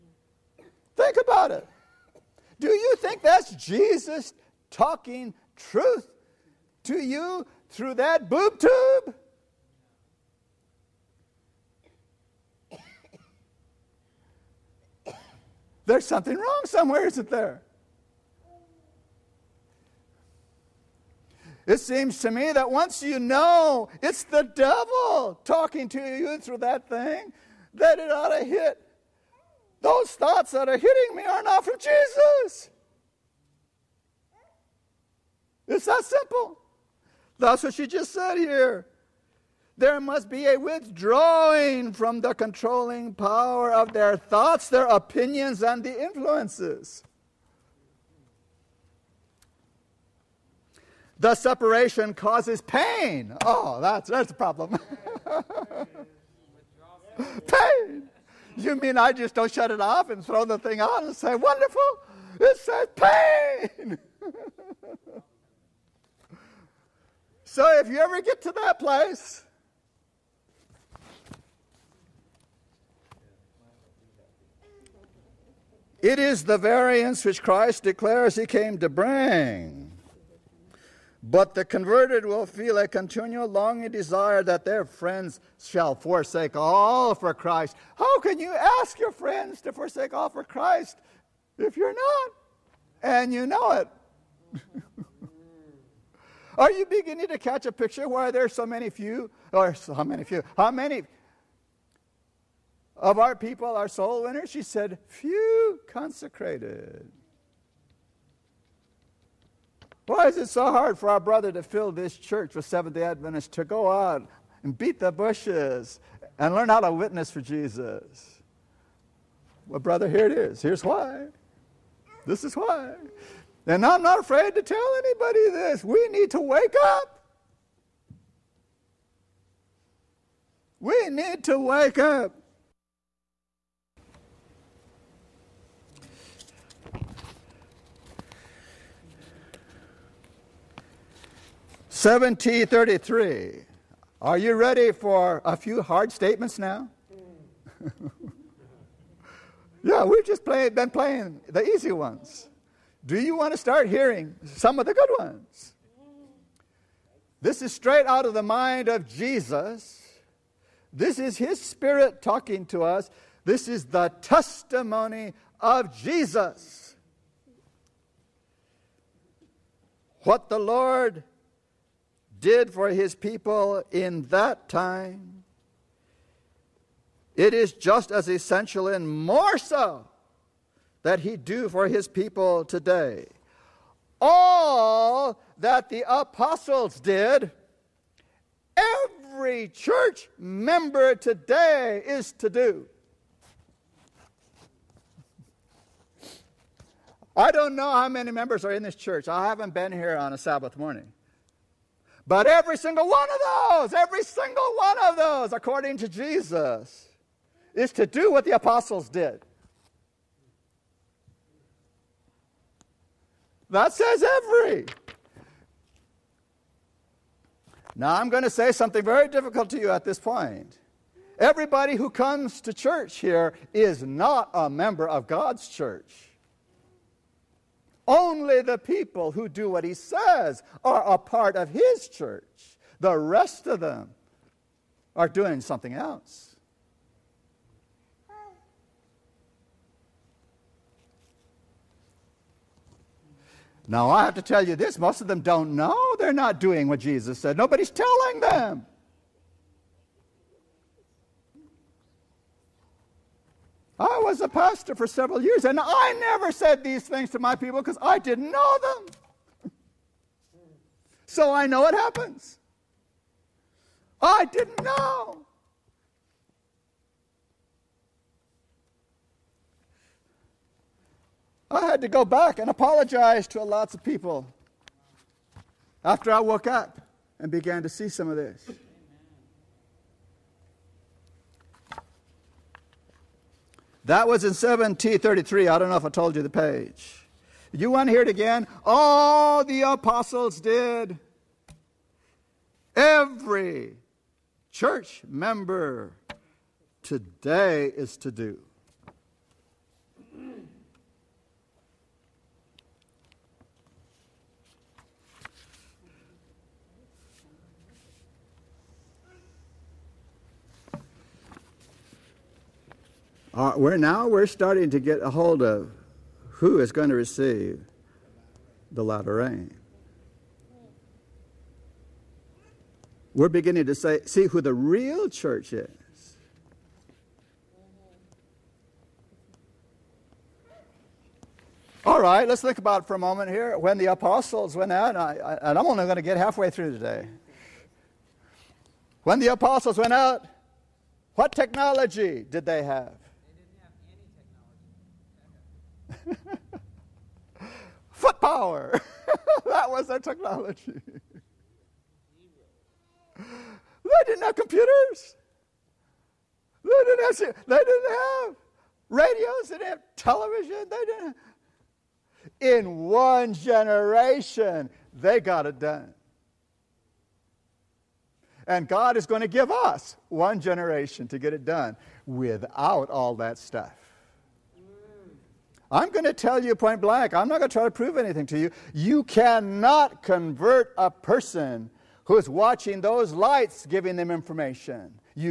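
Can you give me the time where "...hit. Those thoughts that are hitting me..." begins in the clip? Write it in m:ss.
0:28.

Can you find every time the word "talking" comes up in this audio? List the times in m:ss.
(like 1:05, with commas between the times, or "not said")
0:04, 0:25, 2:42.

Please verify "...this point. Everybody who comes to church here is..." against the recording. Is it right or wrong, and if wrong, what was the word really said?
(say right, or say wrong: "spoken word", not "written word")
right.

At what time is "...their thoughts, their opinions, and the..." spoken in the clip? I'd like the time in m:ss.
0:43.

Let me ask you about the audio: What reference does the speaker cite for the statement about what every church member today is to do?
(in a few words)
7T 33.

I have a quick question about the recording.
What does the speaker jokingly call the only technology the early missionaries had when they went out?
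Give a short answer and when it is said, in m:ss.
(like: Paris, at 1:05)
Foot power, at 5:48.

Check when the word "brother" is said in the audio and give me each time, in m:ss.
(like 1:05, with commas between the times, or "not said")
1:51, 1:59.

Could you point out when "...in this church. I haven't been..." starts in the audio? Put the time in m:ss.
3:18.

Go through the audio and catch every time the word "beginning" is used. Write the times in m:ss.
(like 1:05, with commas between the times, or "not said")
1:36, 5:23.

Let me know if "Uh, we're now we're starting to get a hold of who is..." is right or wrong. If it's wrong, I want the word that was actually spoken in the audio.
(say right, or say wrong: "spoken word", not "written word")
right.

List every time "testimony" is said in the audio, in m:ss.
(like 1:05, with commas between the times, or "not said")
2:44.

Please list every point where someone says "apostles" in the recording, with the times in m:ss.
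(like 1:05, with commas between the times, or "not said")
3:06, 3:28, 4:49, 5:34, 5:39.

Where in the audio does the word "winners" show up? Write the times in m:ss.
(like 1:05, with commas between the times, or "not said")
1:44.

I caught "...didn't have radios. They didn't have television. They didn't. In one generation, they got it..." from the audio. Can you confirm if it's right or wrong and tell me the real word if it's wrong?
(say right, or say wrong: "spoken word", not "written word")
right.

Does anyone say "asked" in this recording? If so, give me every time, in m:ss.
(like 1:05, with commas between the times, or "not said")
not said.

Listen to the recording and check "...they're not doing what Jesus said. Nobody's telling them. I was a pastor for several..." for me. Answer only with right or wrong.
right.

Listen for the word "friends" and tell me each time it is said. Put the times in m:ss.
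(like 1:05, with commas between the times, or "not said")
1:24, 1:29.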